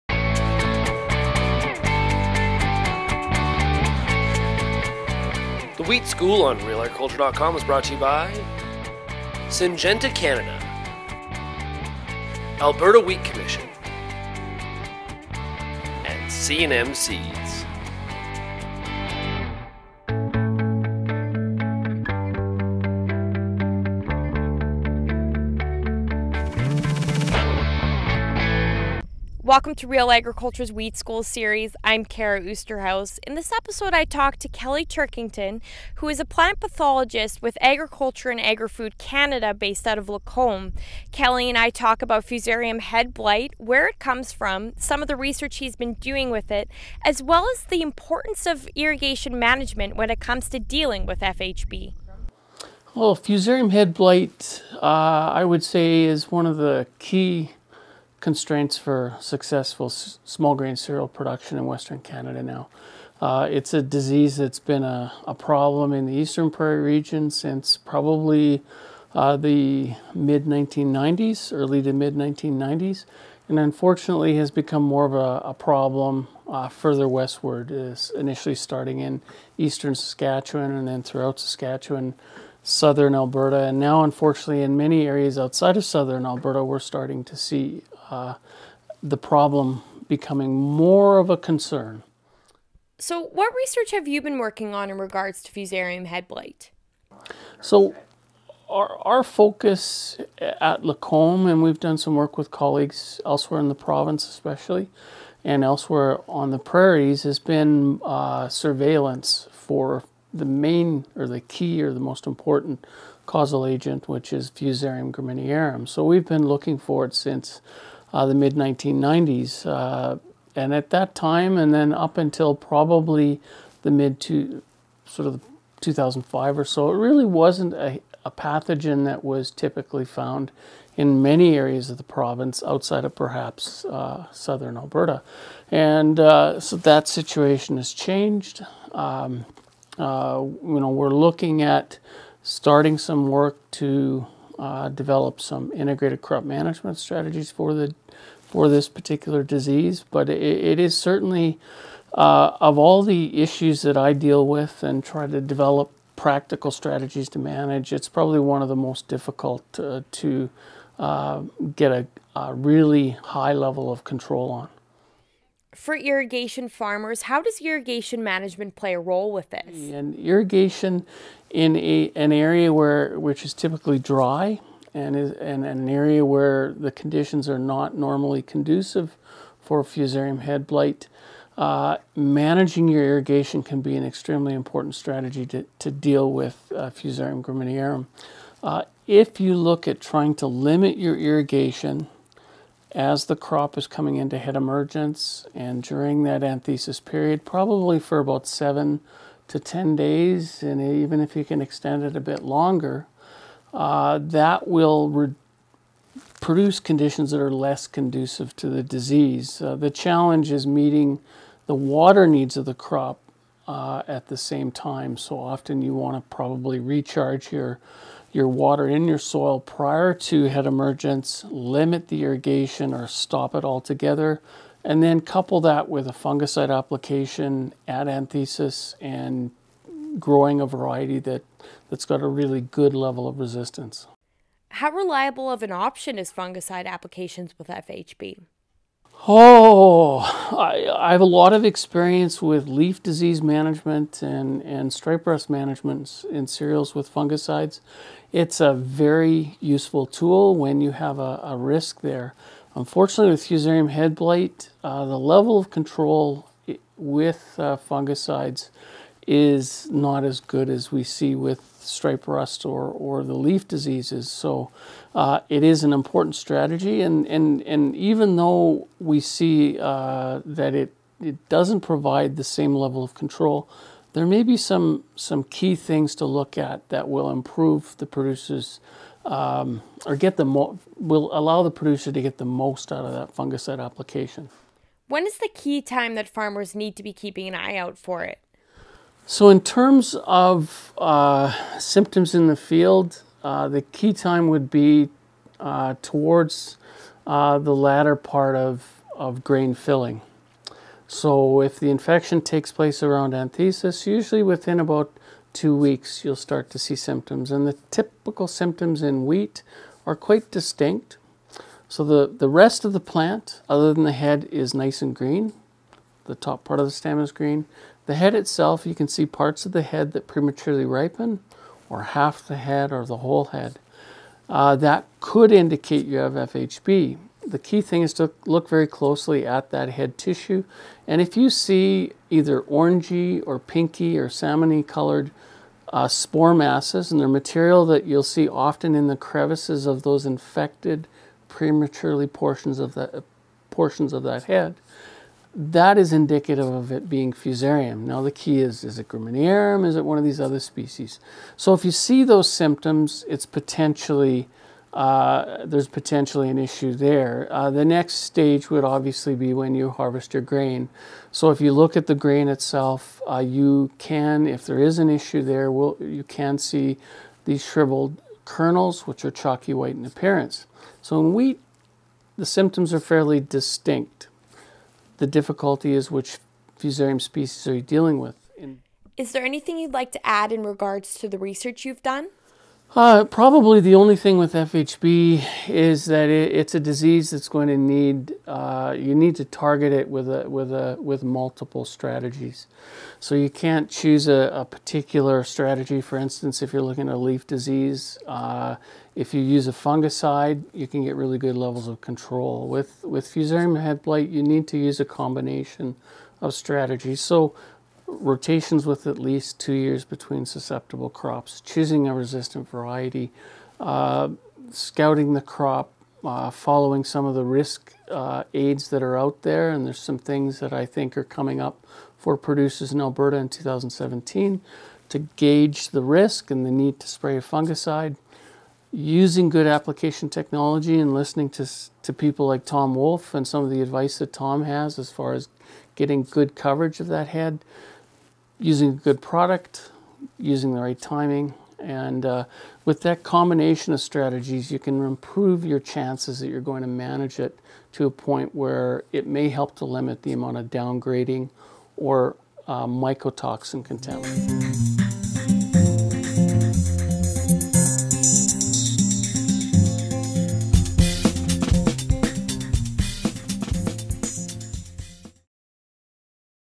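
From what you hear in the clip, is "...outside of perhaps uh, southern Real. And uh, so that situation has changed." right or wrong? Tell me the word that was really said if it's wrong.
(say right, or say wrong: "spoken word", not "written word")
wrong: "Alberta", not "Real".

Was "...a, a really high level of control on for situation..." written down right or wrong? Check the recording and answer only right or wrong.
wrong.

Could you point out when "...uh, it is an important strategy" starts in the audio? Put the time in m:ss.
4:25.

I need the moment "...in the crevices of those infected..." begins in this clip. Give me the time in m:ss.
5:38.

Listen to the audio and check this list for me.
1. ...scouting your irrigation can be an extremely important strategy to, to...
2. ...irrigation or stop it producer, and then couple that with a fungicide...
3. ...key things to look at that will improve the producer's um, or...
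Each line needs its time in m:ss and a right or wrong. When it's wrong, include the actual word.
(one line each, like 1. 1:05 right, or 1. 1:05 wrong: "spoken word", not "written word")
1. 3:02 wrong: "managing", not "scouting"
2. 3:42 wrong: "altogether", not "producer"
3. 4:35 right.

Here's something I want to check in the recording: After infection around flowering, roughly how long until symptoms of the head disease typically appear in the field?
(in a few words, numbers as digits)
about two weeks.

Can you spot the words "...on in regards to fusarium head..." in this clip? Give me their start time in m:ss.
1:34.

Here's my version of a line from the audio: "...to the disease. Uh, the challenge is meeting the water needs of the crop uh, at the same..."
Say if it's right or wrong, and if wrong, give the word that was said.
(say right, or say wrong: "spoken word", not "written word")
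right.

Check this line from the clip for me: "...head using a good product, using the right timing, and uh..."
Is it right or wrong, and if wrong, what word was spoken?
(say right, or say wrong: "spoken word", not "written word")
right.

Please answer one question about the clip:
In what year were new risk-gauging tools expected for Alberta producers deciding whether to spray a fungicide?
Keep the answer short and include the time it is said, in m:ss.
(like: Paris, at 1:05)
2017, at 7:03.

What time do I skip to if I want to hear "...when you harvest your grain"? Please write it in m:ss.
5:59.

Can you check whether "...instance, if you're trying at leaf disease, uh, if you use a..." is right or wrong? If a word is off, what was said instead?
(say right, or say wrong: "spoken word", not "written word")
wrong: "looking", not "trying".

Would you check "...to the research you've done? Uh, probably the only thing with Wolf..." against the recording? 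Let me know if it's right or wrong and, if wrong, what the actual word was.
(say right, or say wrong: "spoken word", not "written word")
wrong: "FHB", not "Wolf".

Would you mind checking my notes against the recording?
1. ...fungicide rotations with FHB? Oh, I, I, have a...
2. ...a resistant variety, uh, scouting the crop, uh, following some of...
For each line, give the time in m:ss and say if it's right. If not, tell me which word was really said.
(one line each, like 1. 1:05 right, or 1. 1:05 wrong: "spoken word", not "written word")
1. 3:56 wrong: "applications", not "rotations"
2. 6:52 right.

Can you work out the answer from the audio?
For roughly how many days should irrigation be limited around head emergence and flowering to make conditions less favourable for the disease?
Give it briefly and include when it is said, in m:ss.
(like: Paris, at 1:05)
7 to 10 days, at 3:18.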